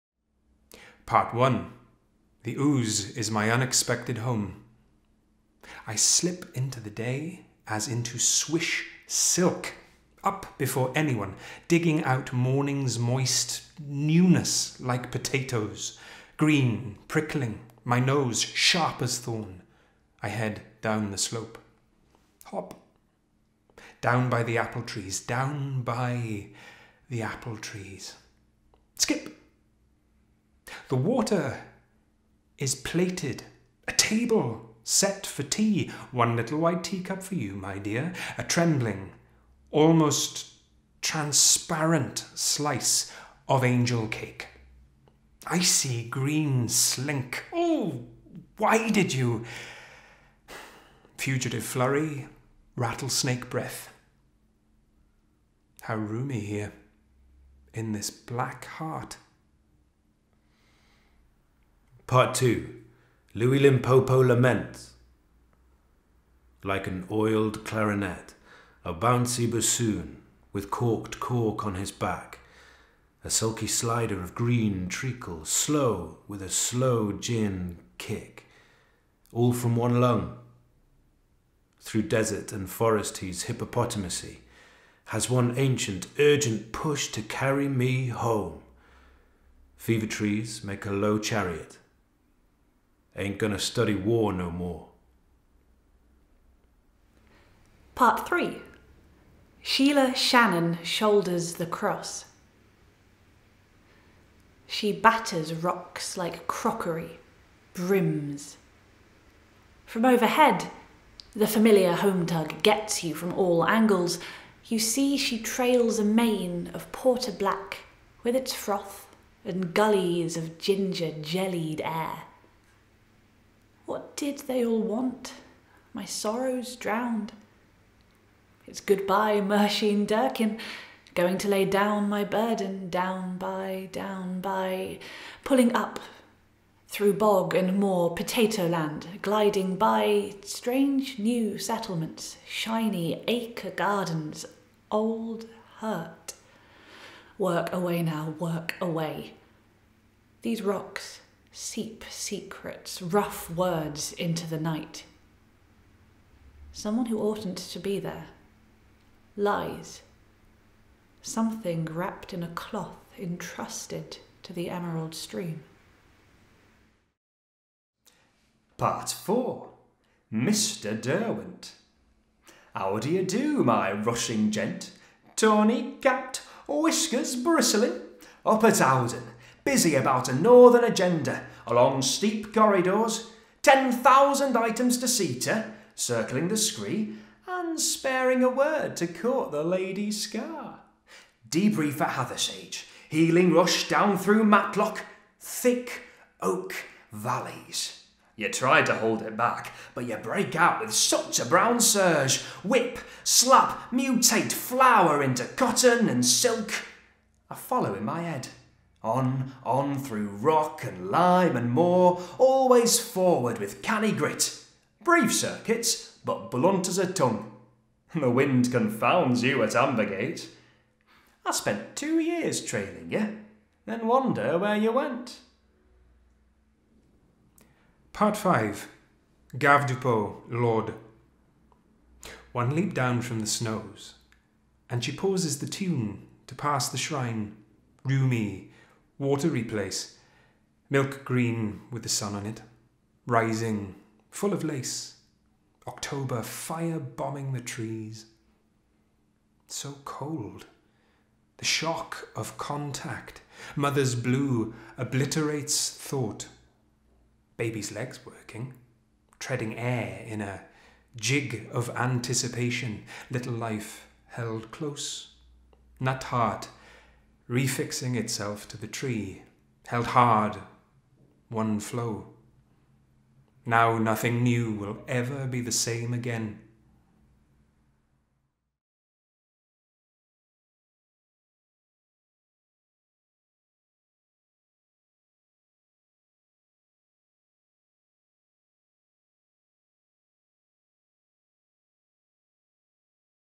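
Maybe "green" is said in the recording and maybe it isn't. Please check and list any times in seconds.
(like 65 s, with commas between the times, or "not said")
16 s, 46 s, 74 s, 241 s.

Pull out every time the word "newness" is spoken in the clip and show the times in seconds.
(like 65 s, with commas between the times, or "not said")
13 s.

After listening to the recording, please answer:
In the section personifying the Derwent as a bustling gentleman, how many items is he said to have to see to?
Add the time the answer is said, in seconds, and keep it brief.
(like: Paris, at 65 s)
10,000, at 183 s.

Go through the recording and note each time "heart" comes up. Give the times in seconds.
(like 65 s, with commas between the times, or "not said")
58 s, 266 s.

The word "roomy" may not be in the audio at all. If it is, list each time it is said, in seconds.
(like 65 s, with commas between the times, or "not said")
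55 s, 238 s.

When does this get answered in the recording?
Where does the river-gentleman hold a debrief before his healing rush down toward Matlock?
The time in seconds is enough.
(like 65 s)
192 s.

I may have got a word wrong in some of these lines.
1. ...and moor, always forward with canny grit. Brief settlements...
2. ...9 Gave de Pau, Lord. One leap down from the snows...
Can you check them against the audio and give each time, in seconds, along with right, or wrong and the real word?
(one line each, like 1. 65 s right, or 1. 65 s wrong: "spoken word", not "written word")
1. 211 s wrong: "circuits", not "settlements"
2. 228 s wrong: "5", not "9".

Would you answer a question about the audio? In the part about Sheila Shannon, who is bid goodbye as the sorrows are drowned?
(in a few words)
Mershin Durkin.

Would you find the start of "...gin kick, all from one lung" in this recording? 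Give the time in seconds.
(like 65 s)
77 s.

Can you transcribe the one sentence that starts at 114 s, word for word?
You see she trails a mane of porter black with its froth and gullies of ginger jellied air.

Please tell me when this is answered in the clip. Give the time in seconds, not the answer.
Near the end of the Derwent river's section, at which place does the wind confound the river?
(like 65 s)
219 s.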